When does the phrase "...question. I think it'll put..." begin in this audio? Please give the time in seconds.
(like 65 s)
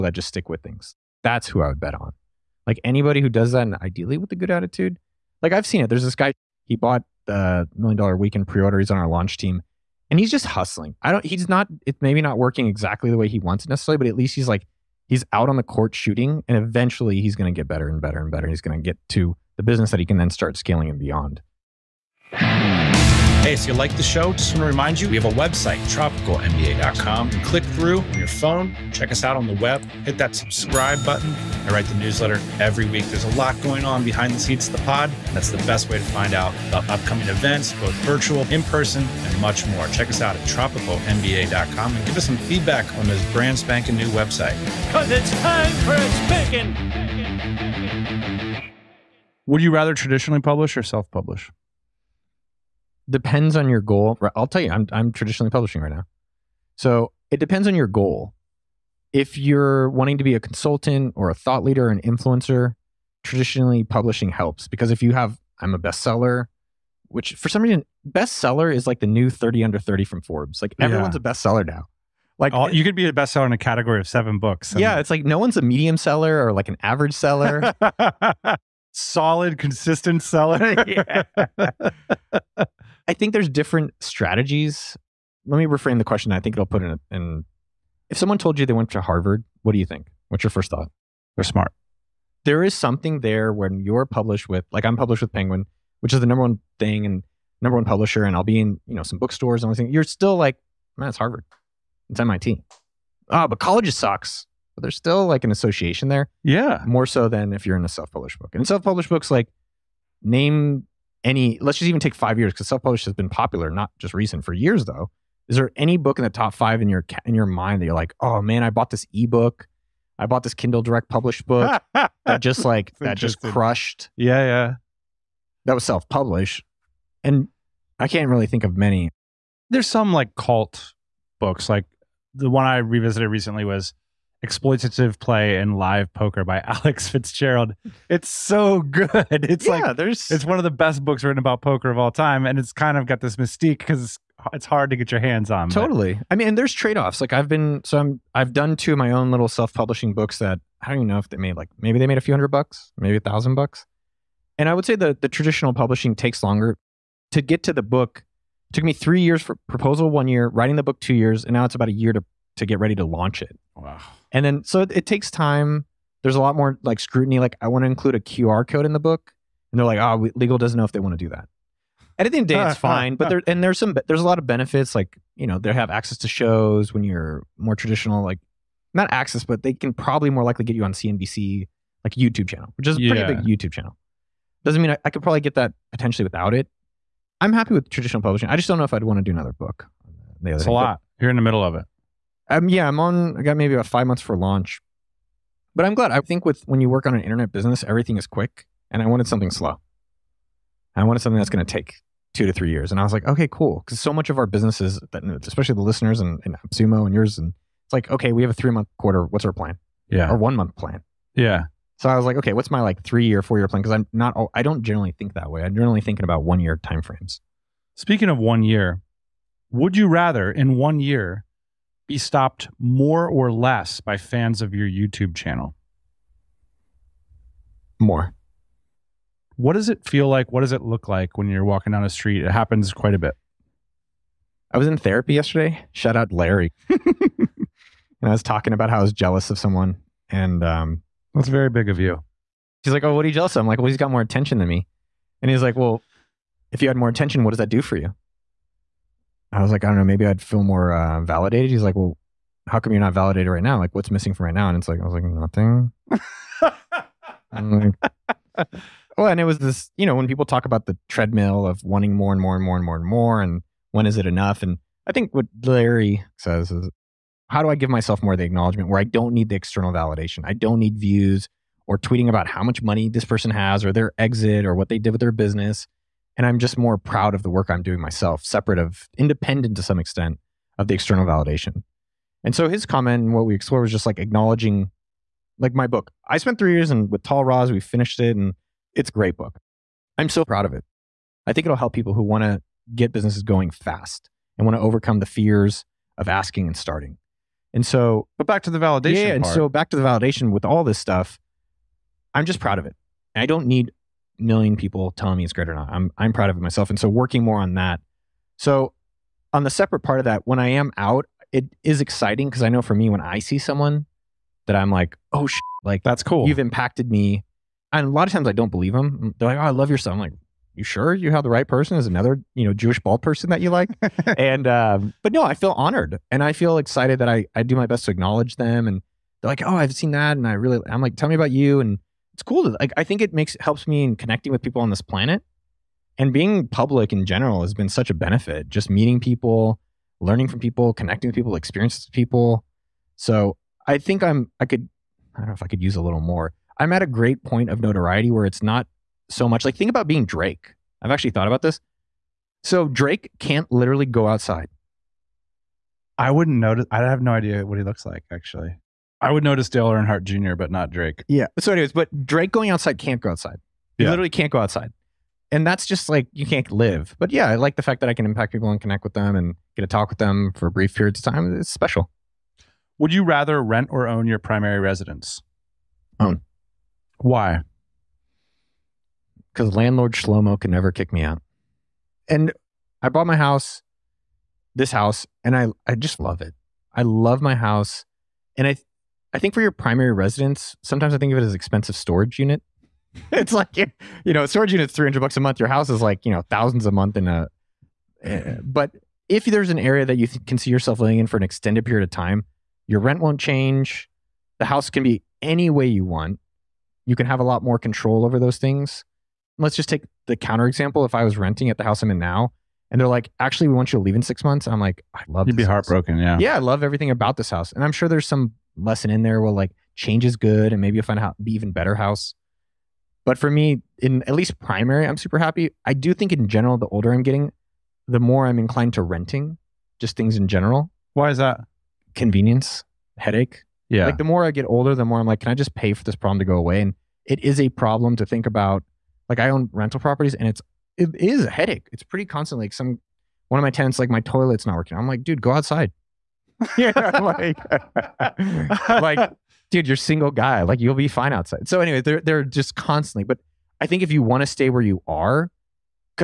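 86 s.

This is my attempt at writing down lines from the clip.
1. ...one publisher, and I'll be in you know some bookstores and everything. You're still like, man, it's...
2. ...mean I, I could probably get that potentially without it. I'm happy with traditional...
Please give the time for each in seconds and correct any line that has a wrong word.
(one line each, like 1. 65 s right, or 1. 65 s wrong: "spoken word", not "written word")
1. 97 s right
2. 184 s right.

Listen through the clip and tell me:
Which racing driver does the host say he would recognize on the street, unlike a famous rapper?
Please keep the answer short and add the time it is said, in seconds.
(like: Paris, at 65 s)
Dale Earnhardt Jr., at 359 s.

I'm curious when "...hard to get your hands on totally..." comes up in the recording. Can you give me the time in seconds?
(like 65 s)
144 s.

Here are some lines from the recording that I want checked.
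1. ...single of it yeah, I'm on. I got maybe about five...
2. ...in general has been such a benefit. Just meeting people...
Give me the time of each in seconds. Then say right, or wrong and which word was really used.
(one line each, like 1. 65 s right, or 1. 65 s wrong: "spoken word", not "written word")
1. 191 s wrong: "middle", not "single"
2. 337 s right.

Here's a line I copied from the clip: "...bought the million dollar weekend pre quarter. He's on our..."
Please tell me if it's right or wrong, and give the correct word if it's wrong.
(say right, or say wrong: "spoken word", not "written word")
wrong: "order", not "quarter".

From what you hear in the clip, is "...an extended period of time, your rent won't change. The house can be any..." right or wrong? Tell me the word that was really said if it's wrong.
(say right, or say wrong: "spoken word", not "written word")
right.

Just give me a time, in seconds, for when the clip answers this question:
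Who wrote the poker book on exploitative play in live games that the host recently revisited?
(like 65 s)
136 s.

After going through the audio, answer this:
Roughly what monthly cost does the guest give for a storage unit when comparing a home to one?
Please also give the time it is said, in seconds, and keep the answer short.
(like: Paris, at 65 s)
$300, at 394 s.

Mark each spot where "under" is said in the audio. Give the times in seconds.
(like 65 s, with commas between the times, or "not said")
69 s.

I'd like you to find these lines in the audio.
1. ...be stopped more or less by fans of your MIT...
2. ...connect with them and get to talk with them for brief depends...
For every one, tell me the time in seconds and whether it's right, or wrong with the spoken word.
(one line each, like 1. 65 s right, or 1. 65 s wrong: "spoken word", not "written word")
1. 222 s wrong: "YouTube", not "MIT"
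2. 368 s wrong: "periods", not "depends".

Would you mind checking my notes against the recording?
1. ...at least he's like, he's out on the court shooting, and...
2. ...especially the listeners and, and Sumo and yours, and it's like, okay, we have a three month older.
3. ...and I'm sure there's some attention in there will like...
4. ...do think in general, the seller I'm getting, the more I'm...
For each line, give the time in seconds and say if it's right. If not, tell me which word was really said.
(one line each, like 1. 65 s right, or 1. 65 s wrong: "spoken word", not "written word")
1. 14 s right
2. 205 s wrong: "quarter", not "older"
3. 417 s wrong: "lesson", not "attention"
4. 425 s wrong: "older", not "seller".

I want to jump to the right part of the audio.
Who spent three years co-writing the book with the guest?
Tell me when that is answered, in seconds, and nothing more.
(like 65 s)
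287 s.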